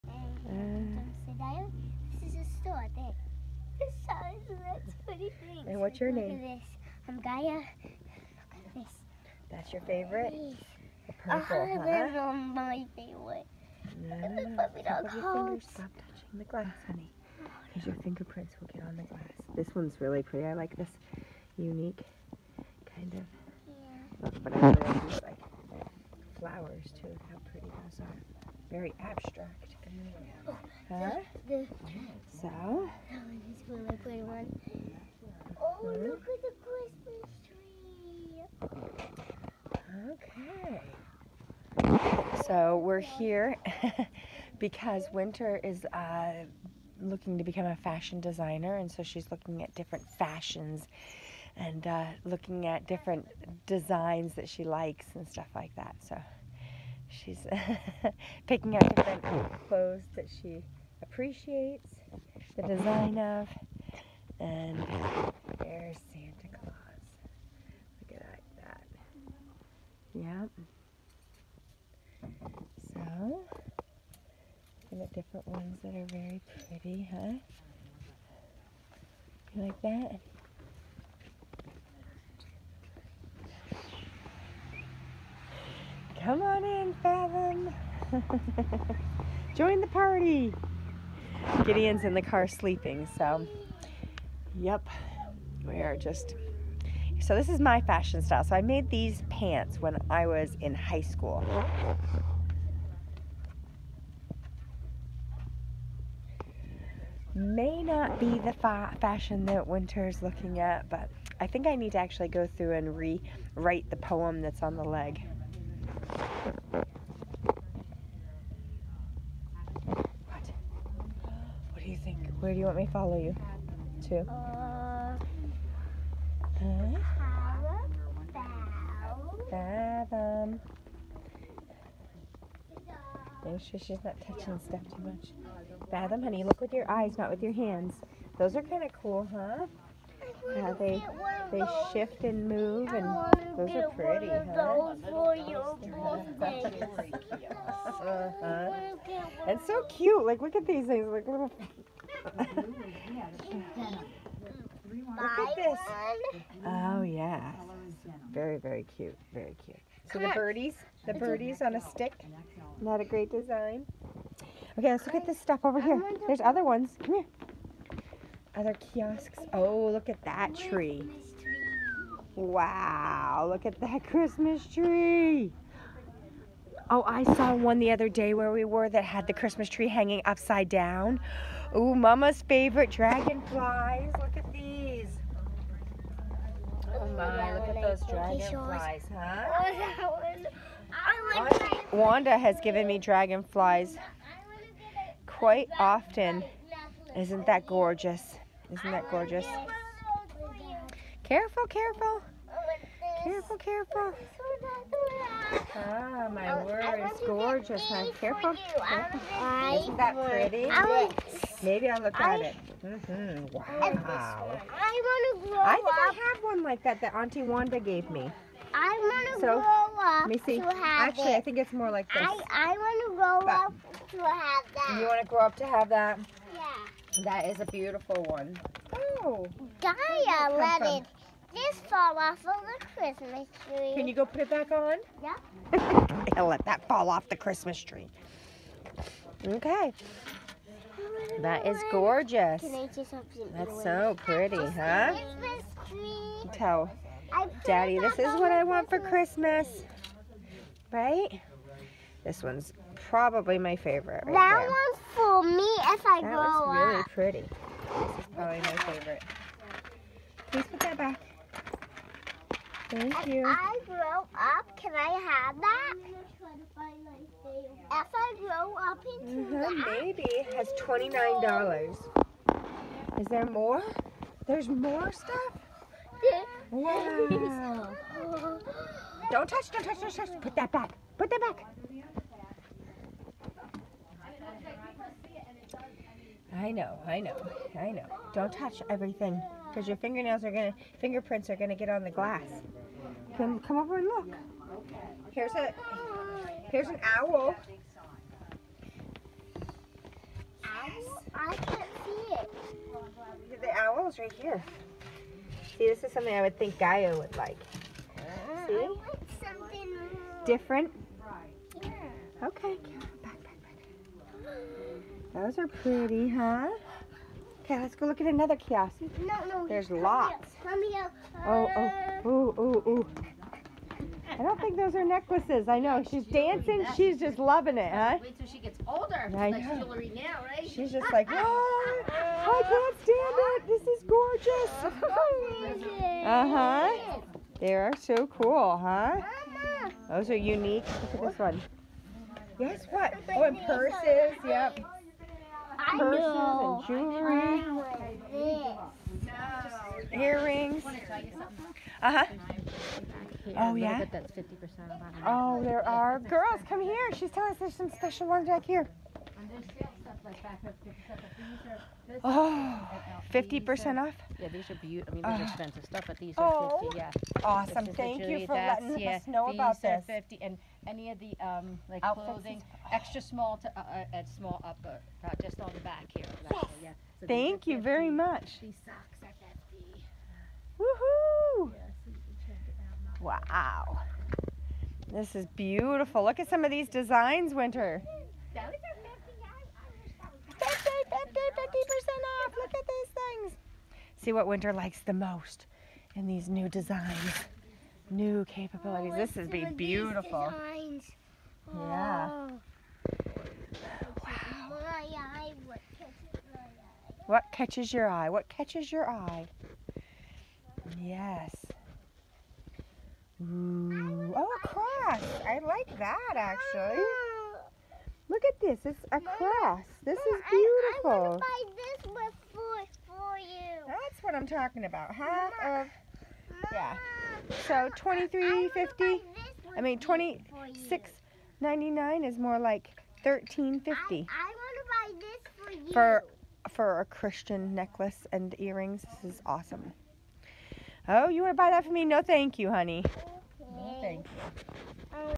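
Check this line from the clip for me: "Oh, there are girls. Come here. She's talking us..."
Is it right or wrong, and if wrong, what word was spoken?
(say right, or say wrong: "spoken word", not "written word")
wrong: "telling", not "talking".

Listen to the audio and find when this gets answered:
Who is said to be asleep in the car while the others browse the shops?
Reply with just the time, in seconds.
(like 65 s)
91 s.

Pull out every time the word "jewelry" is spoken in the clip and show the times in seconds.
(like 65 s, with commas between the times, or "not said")
329 s, 346 s.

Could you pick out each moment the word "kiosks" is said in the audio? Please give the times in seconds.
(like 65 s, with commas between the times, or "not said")
168 s, 318 s.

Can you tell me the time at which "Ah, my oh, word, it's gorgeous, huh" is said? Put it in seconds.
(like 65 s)
205 s.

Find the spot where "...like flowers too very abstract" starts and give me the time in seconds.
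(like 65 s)
25 s.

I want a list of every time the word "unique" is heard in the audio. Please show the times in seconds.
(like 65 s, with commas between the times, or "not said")
21 s, 340 s.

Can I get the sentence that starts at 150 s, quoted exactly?
Like, look at these things, like little.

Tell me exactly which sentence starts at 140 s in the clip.
how they they shift and move, and those are pretty, huh?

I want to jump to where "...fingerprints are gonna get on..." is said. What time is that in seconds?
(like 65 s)
290 s.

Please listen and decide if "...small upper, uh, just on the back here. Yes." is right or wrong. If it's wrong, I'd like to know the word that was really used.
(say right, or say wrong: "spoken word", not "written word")
right.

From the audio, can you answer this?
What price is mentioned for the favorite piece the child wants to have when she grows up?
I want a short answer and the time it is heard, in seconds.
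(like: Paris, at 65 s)
$29, at 270 s.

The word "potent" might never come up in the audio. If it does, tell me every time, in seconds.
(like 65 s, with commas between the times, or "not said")
not said.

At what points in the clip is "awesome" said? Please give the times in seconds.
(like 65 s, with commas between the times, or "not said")
367 s, 439 s.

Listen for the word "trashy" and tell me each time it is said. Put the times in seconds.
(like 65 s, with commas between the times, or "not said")
not said.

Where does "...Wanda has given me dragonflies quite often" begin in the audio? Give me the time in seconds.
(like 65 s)
191 s.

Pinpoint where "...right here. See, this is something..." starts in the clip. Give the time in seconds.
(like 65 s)
304 s.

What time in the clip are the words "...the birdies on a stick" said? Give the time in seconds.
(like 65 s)
161 s.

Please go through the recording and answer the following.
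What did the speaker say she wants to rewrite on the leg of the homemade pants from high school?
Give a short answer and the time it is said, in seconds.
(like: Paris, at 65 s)
the poem, at 113 s.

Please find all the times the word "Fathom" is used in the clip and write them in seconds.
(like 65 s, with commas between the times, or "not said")
87 s, 129 s, 135 s.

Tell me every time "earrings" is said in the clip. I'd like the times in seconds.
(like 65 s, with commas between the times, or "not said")
350 s, 438 s.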